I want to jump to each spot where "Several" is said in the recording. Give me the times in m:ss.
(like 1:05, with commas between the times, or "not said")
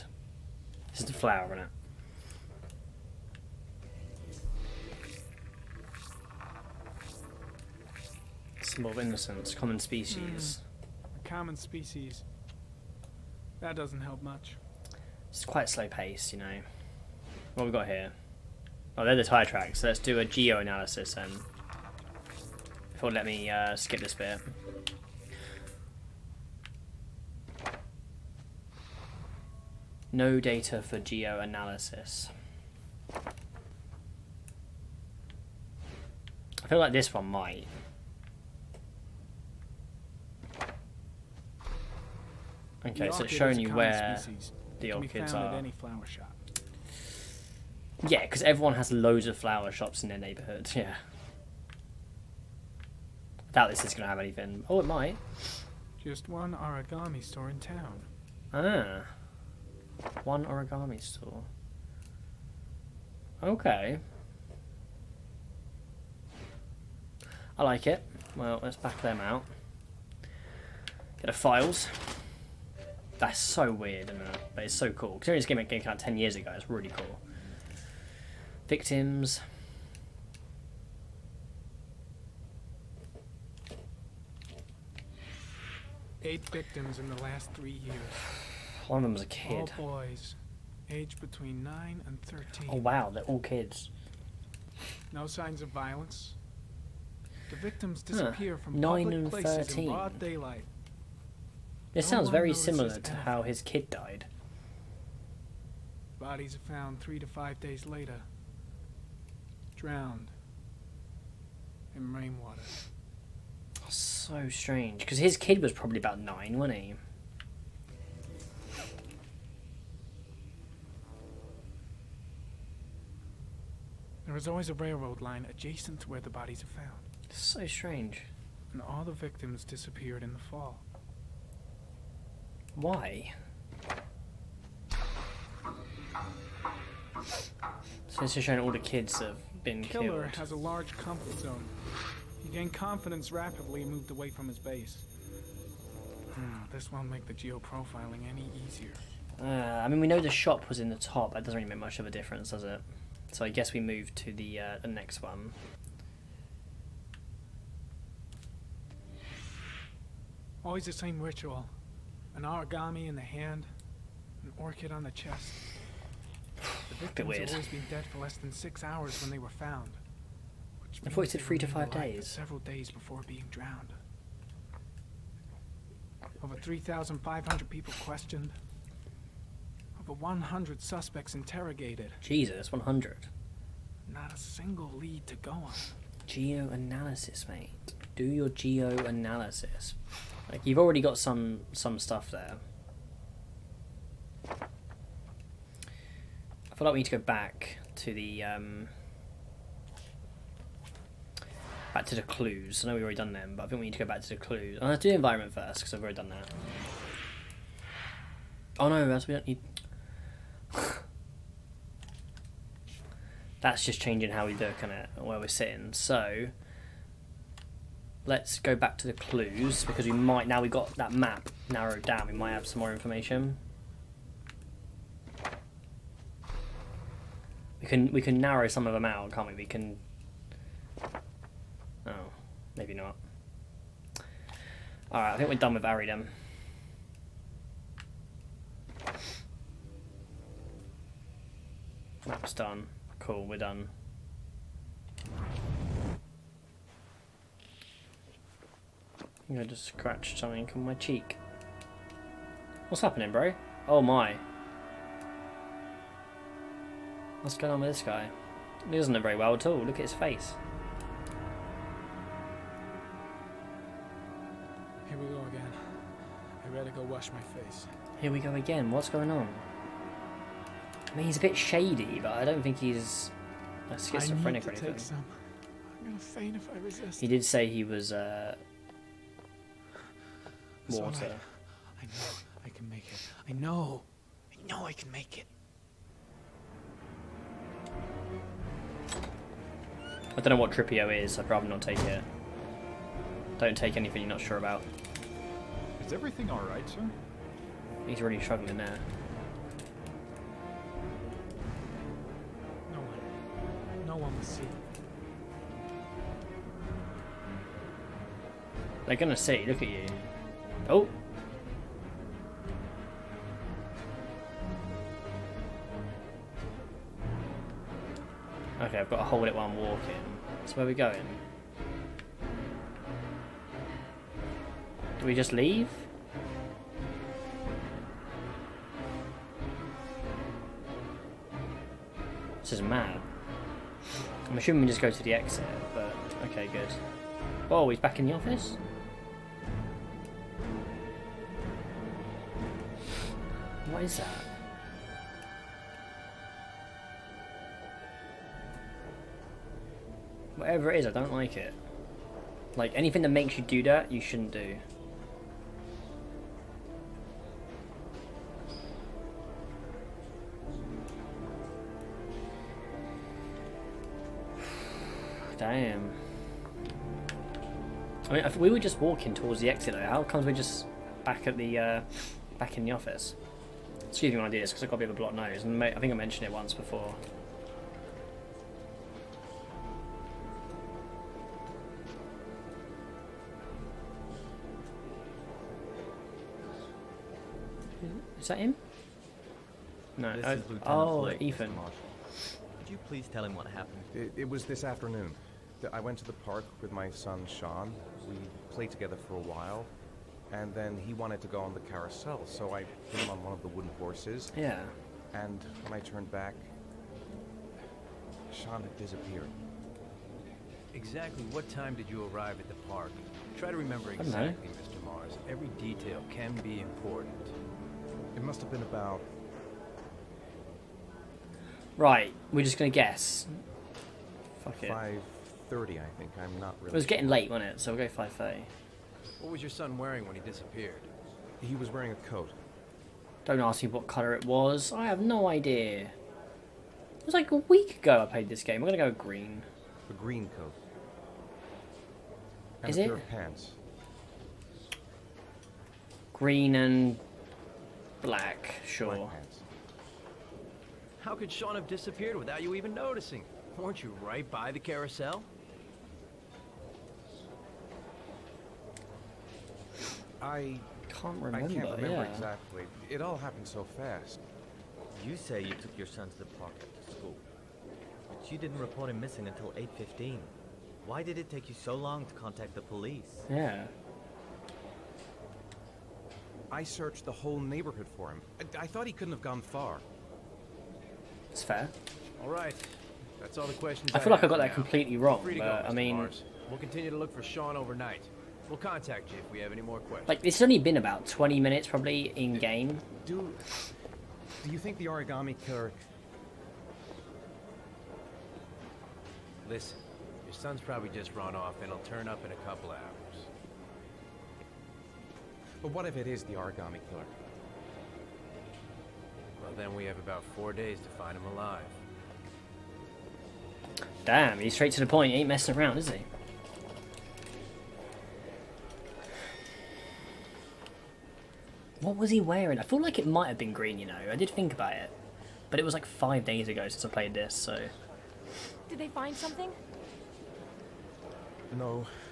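2:52.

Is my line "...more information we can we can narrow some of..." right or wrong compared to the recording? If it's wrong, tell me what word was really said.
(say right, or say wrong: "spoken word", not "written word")
right.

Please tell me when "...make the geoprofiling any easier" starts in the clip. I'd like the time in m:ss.
2:27.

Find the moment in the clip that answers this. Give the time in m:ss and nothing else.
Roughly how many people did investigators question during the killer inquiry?
2:56.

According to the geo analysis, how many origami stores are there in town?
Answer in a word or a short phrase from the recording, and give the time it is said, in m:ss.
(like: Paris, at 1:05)
1, at 0:56.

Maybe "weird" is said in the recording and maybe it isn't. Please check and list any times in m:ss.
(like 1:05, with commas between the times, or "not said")
1:13.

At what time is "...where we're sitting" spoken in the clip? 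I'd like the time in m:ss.
3:35.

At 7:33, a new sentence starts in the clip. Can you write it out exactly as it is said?
Weren't you right by the carousel?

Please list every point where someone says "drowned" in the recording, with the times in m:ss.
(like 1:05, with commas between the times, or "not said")
1:49, 2:53.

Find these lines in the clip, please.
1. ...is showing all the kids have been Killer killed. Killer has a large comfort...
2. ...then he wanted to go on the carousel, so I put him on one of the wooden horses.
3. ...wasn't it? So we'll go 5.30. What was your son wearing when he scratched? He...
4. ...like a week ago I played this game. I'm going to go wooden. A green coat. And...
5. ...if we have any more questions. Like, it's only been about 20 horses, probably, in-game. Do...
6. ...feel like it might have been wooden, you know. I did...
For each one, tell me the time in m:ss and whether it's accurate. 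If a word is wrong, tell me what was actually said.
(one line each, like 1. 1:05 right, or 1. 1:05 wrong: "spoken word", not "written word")
1. 2:18 right
2. 6:40 right
3. 7:07 wrong: "disappeared", not "scratched"
4. 7:17 wrong: "green", not "wooden"
5. 8:09 wrong: "minutes", not "horses"
6. 8:42 wrong: "green", not "wooden".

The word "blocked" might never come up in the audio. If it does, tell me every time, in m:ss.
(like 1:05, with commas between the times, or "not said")
6:15.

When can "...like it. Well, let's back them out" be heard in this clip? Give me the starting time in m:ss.
1:07.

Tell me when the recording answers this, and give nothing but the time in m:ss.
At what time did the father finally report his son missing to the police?
7:49.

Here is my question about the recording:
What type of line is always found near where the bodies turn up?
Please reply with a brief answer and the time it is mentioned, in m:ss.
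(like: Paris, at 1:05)
Railroad line, at 2:04.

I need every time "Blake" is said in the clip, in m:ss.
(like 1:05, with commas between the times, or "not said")
6:31.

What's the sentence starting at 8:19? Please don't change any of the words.
Listen, your son's probably just run off and he'll turn up in a couple hours.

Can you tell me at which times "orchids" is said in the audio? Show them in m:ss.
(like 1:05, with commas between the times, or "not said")
0:44, 2:44.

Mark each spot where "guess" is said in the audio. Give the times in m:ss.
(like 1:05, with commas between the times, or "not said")
2:33, 7:02.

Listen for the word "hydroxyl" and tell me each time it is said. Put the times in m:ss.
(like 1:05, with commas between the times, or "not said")
not said.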